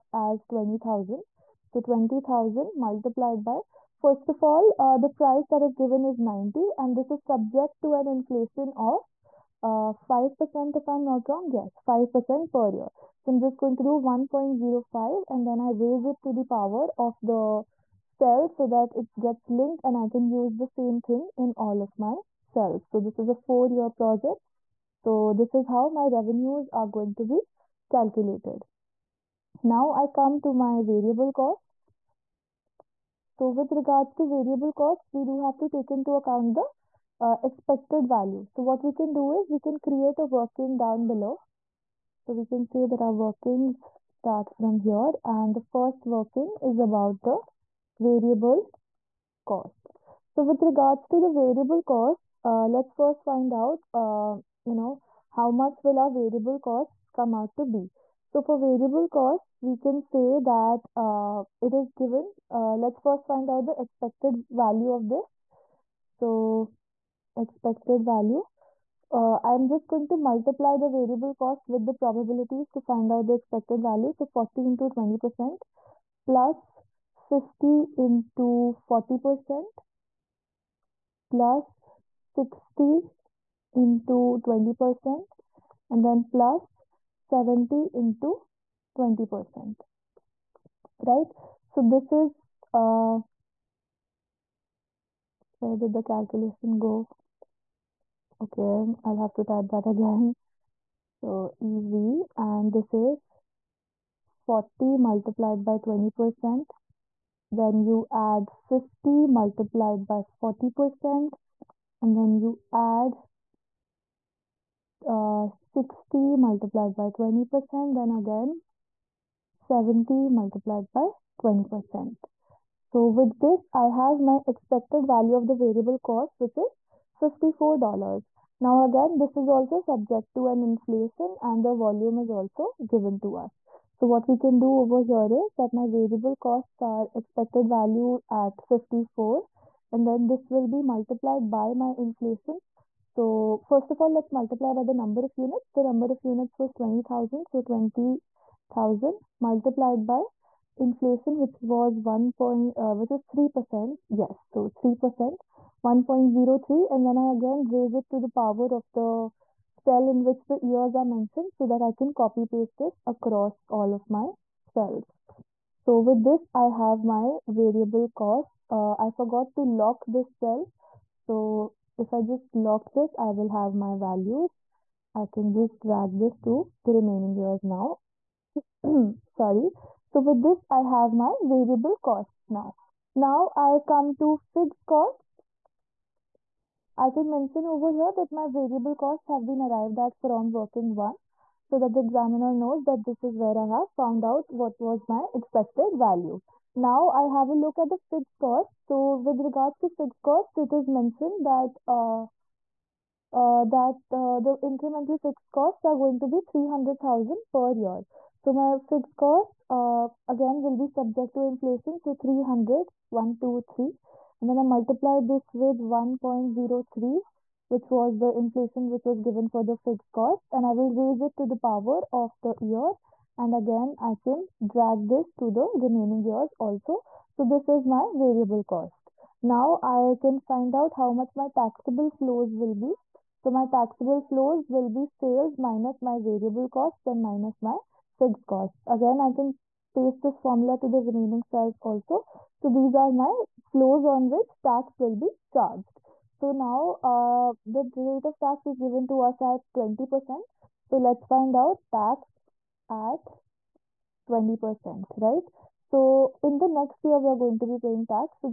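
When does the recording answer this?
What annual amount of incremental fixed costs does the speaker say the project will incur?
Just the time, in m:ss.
3:26.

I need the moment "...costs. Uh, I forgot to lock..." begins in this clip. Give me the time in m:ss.
2:48.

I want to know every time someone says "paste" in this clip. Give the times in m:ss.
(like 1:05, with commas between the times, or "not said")
2:42, 3:59.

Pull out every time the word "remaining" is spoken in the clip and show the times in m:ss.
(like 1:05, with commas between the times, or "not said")
2:56, 3:45, 4:01.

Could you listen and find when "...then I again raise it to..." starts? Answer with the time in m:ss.
2:37.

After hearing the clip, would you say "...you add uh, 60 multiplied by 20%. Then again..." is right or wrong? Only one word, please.
right.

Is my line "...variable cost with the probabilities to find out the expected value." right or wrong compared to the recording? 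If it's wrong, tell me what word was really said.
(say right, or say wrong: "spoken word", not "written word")
right.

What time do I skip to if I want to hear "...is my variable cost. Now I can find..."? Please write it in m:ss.
3:47.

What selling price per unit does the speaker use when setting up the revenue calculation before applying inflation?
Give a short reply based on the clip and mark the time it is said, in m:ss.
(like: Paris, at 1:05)
90, at 0:06.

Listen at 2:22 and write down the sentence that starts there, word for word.
So first of all, let's multiply by the number of units.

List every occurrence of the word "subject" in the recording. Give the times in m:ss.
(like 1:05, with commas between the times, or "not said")
0:07, 2:09, 3:30.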